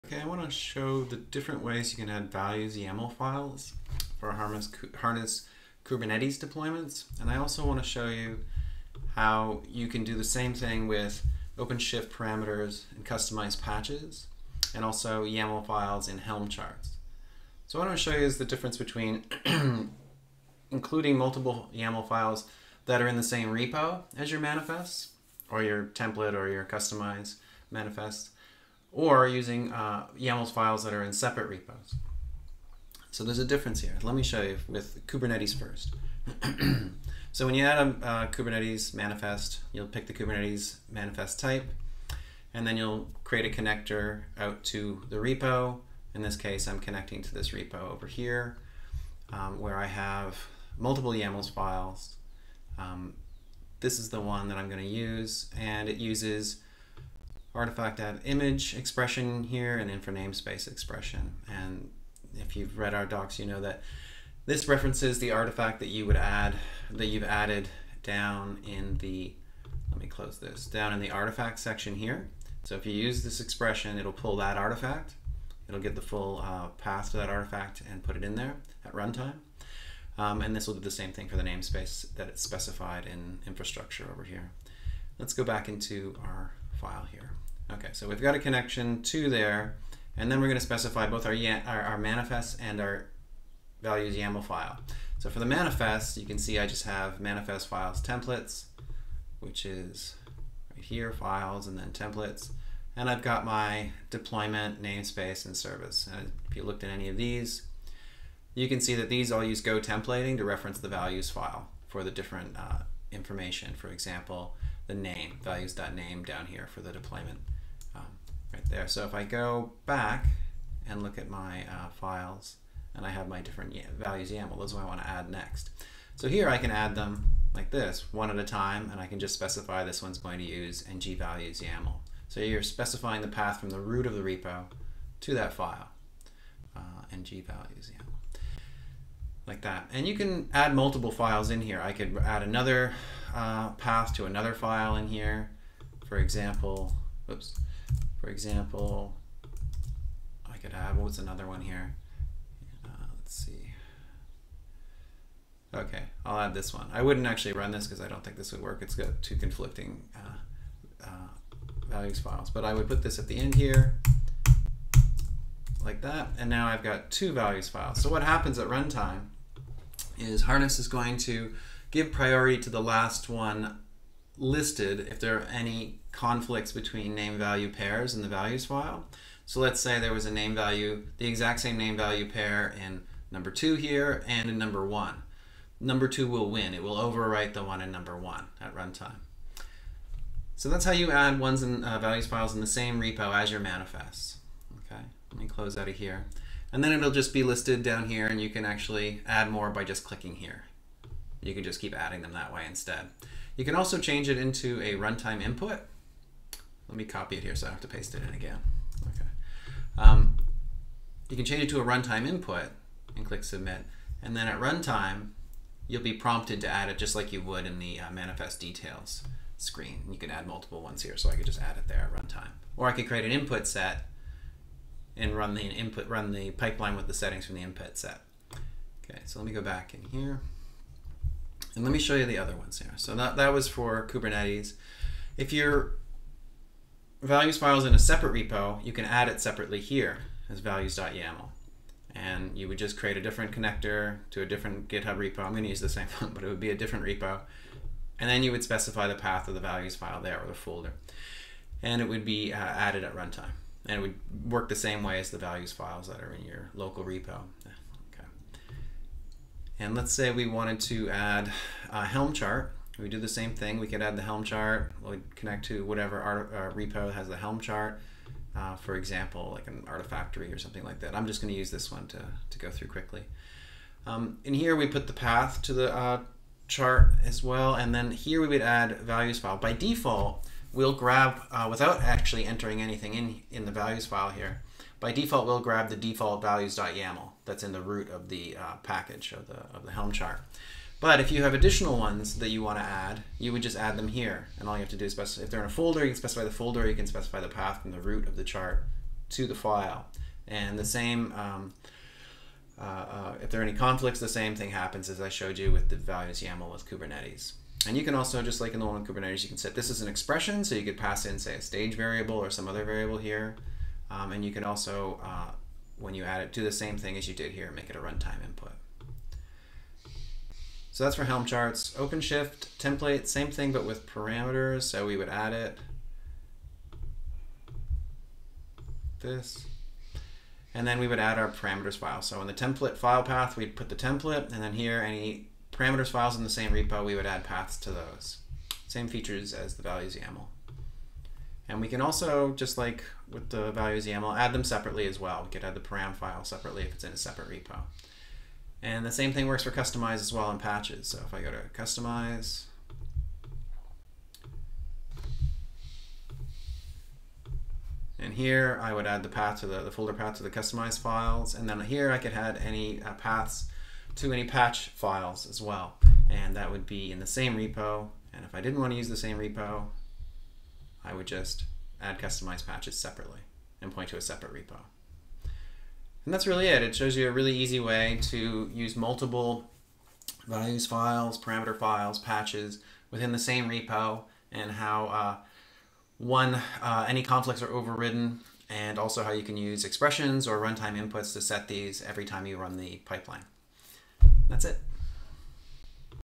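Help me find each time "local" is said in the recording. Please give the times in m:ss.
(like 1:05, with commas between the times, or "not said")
4:16.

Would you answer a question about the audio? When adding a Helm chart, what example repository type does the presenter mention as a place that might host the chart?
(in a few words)
Artifactory.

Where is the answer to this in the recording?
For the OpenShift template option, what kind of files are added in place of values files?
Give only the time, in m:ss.
5:31.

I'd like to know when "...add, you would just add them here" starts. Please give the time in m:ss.
4:52.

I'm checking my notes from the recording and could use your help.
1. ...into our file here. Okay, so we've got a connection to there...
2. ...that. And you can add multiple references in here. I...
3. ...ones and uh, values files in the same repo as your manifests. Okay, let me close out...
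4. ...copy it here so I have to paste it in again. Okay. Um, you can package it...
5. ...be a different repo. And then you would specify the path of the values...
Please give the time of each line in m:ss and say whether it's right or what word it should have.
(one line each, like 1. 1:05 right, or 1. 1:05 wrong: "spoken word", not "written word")
1. 1:25 right
2. 2:19 wrong: "files", not "references"
3. 3:11 right
4. 3:27 wrong: "change", not "package"
5. 4:06 right.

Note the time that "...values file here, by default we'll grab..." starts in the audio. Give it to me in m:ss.
4:43.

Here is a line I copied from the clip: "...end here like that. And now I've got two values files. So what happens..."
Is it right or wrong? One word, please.
right.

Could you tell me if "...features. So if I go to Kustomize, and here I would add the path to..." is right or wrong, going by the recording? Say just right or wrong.
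wrong.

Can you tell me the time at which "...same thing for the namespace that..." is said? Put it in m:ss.
1:20.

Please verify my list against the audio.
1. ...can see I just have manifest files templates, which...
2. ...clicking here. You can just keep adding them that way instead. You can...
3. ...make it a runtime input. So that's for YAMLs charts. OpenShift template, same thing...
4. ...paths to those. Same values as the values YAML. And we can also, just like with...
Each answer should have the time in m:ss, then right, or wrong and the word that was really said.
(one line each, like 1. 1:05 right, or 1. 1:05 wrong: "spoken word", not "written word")
1. 1:36 right
2. 3:20 right
3. 5:17 wrong: "Helm", not "YAMLs"
4. 5:37 wrong: "features", not "values".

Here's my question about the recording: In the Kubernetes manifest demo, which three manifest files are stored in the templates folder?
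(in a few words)
deployment, namespace, and service.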